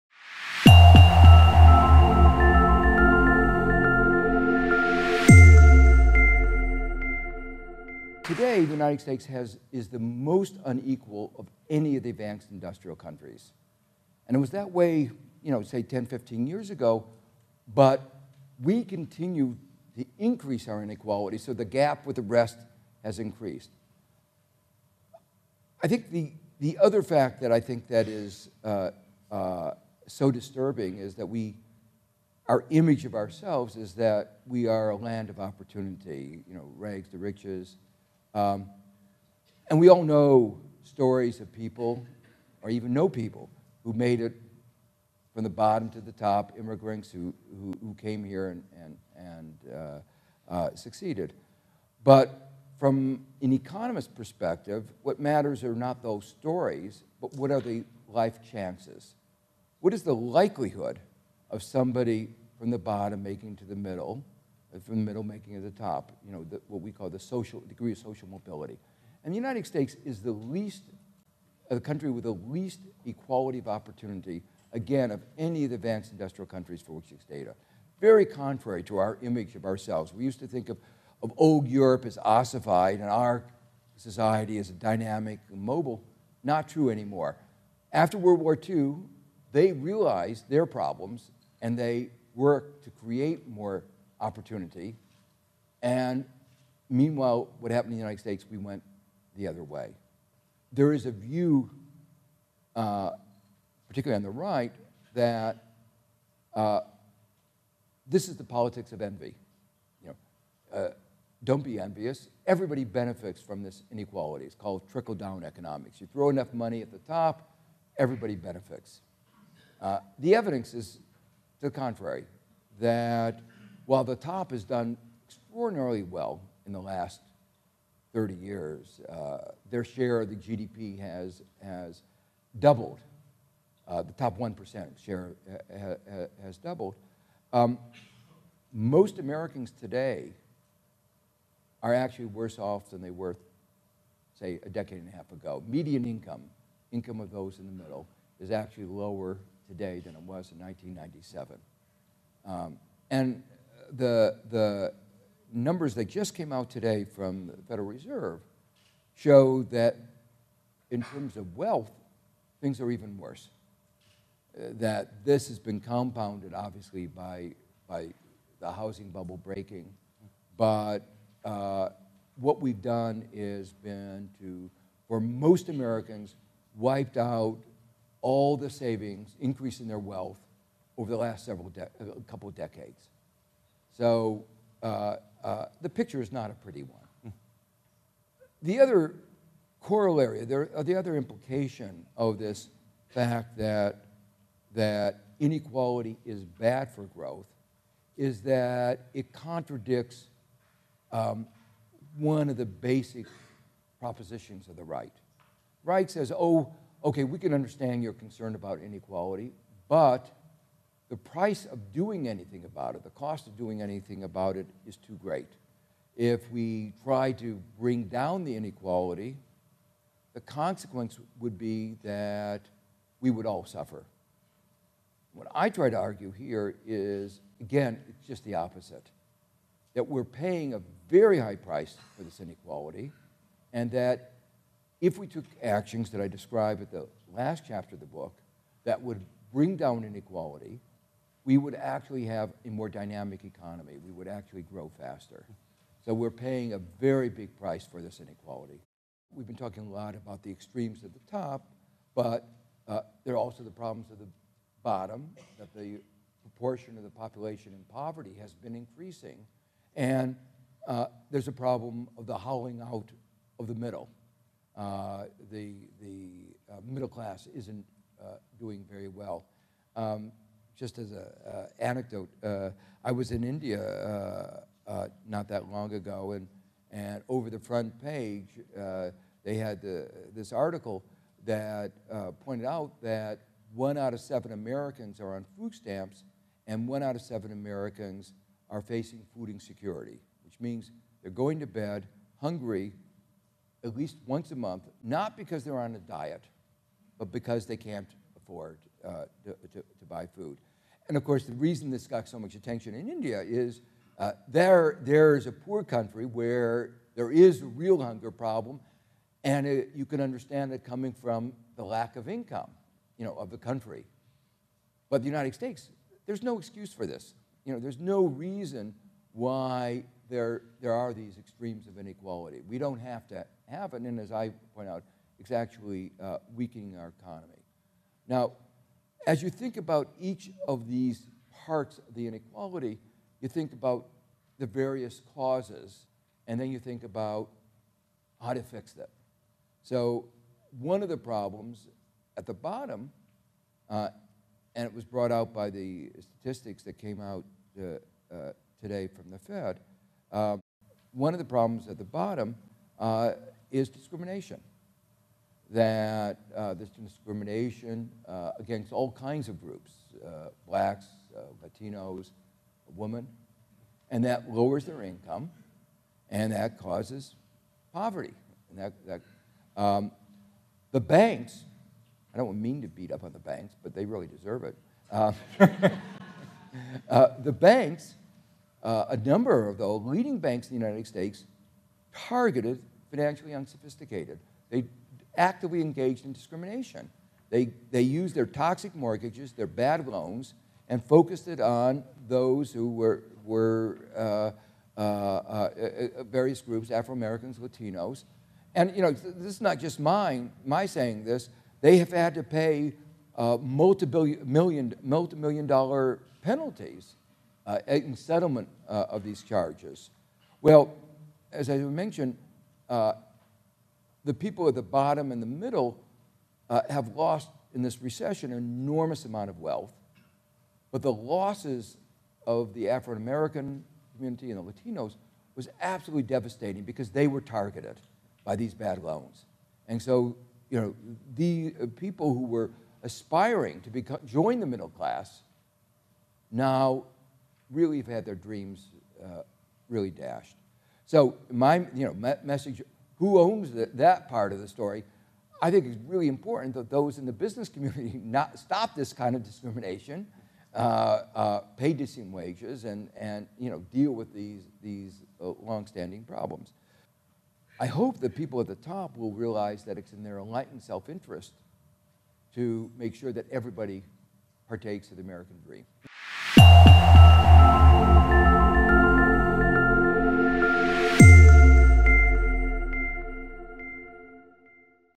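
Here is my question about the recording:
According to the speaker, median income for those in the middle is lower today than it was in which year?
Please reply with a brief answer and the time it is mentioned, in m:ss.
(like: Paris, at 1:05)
1997, at 2:30.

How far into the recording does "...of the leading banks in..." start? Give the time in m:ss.
6:19.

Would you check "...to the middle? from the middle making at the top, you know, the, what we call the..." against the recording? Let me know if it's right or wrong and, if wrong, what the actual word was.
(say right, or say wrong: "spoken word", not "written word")
right.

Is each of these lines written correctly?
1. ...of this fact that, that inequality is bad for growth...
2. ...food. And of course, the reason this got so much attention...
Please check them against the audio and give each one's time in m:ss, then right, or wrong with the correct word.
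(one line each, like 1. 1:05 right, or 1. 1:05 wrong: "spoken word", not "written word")
1. 3:12 right
2. 5:00 right.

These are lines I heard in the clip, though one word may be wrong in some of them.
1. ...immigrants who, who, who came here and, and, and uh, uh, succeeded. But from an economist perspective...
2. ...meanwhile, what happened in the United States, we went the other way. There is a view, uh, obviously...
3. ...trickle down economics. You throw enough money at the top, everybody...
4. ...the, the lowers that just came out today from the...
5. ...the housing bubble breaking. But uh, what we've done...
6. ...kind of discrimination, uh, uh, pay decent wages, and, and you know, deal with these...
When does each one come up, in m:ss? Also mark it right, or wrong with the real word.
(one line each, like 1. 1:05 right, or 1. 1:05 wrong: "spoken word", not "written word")
1. 0:46 right
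2. 1:36 wrong: "particularly", not "obviously"
3. 1:54 right
4. 2:33 wrong: "numbers", not "lowers"
5. 2:48 right
6. 7:29 right.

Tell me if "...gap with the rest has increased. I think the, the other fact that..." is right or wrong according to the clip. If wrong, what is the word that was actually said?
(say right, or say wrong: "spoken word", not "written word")
right.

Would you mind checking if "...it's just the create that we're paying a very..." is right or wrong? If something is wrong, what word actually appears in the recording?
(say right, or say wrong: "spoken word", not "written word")
wrong: "opposite", not "create".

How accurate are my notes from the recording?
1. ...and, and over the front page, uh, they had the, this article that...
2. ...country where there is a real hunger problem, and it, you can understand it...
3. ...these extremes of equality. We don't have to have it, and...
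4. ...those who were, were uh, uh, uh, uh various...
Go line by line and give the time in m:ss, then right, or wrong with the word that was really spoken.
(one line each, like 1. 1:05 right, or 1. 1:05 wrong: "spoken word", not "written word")
1. 4:36 right
2. 5:05 right
3. 5:21 wrong: "inequality", not "equality"
4. 6:32 right.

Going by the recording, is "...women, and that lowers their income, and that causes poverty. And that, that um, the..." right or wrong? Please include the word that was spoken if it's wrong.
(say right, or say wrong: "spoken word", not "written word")
right.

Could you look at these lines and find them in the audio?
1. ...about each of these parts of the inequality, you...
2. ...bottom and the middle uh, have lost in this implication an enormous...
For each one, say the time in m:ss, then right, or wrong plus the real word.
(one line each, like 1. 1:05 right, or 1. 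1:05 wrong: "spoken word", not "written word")
1. 5:29 right
2. 6:54 wrong: "recession", not "implication".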